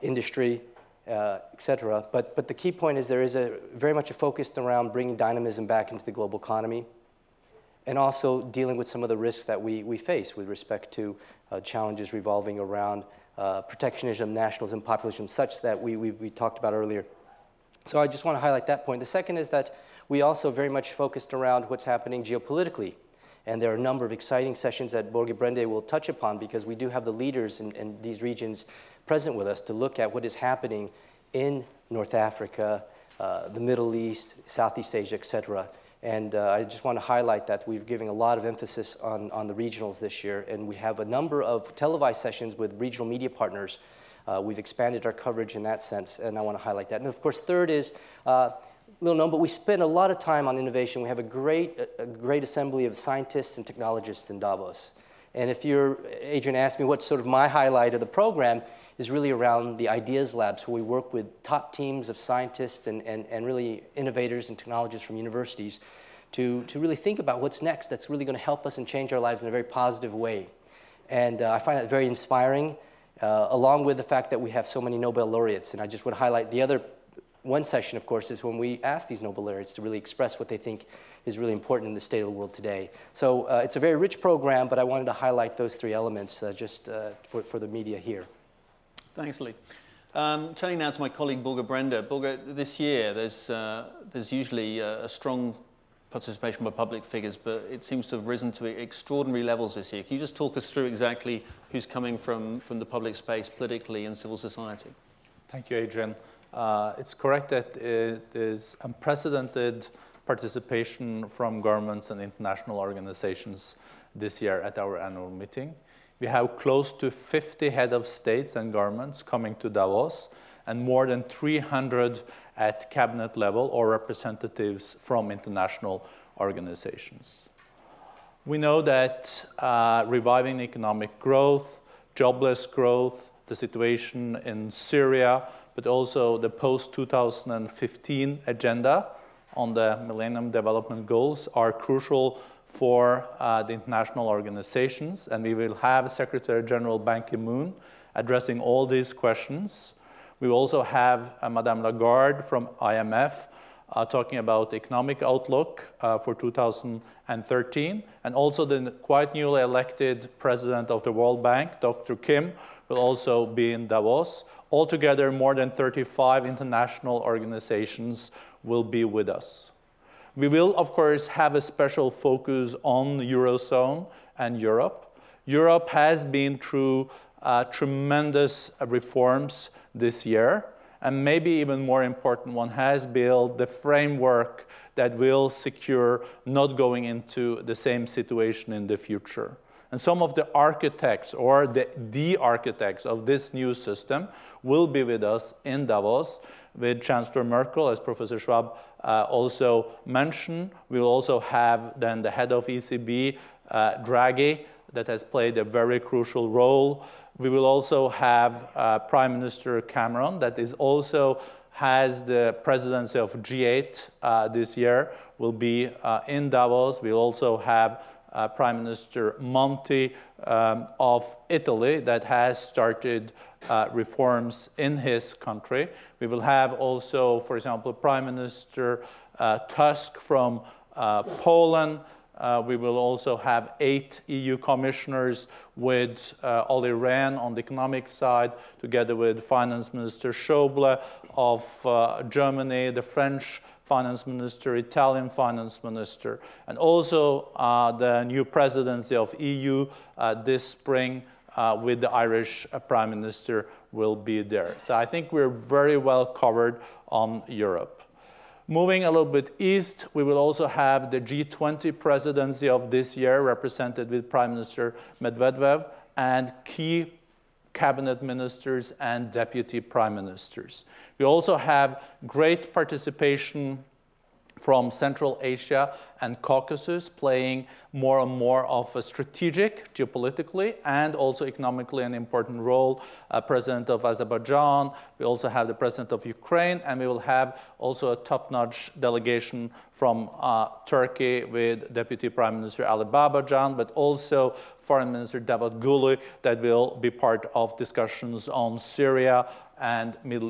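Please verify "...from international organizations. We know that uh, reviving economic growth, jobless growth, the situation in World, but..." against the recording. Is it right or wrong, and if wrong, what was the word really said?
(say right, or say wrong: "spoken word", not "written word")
wrong: "Syria", not "World".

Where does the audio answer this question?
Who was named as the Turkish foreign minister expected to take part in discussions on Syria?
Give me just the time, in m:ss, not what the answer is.
4:55.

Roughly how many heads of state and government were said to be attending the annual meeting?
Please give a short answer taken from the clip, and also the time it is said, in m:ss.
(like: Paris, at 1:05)
close to 50, at 1:56.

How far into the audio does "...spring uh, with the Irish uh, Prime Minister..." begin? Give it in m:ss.
4:10.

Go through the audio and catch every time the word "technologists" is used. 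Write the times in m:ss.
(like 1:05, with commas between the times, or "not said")
0:53, 1:04.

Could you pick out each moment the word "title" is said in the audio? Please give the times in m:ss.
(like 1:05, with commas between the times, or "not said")
not said.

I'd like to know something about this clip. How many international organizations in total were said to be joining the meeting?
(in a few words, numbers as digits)
more than 35.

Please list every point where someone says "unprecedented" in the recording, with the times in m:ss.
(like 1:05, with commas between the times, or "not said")
1:48.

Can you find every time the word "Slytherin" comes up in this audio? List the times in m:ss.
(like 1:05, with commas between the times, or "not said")
not said.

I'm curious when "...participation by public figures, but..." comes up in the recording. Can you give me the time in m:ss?
1:36.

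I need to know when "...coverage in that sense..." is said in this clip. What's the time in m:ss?
0:45.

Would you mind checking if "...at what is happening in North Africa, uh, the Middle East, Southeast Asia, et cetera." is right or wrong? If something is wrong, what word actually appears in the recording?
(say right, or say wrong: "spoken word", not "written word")
right.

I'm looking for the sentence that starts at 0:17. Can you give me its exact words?
So I just want to highlight that point.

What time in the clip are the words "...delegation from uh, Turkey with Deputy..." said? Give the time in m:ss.
4:48.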